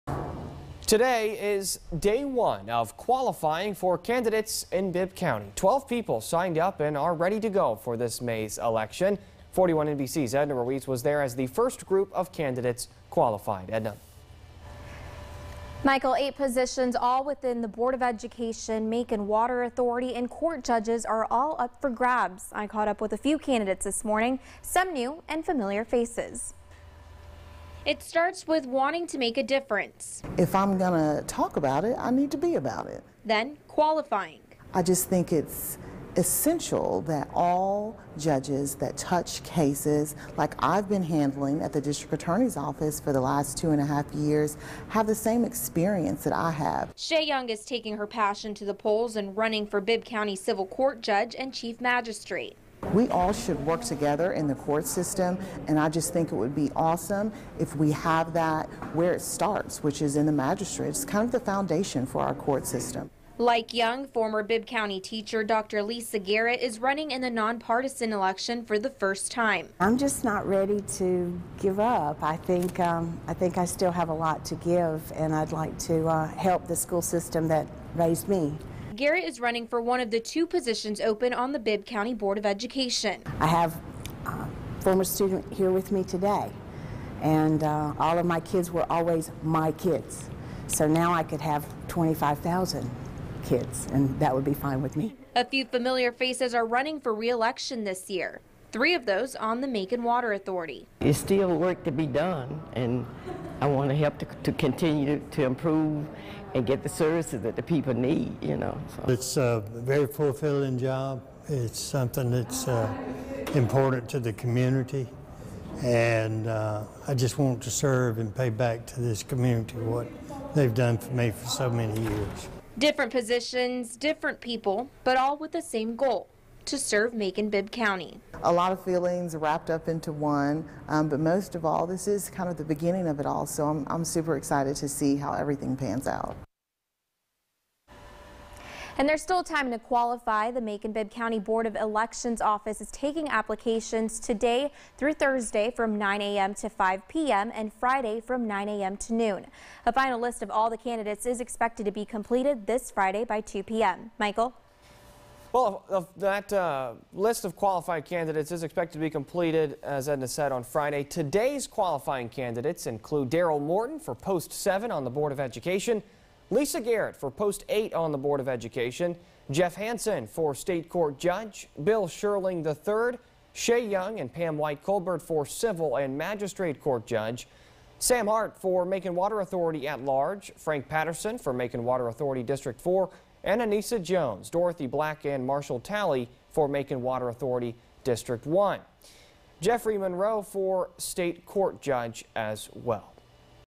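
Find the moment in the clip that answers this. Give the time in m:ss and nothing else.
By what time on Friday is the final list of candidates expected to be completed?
2:33.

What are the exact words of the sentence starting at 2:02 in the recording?
Different positions, different people, but all with the same goal to serve Macon-Bibb County.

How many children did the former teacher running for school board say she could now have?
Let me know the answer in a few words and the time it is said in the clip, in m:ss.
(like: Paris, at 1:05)
25,000, at 1:31.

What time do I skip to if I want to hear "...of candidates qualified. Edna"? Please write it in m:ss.
0:12.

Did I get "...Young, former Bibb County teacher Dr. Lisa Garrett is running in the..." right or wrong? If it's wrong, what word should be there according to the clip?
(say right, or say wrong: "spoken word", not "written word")
right.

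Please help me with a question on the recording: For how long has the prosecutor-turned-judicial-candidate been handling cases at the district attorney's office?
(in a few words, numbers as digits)
two and a half years.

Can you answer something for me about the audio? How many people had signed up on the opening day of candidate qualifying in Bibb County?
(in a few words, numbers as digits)
12.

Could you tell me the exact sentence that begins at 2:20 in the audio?
The Macon-Bibb County Board of Elections office is taking applications today through Thursday from 9 a.m.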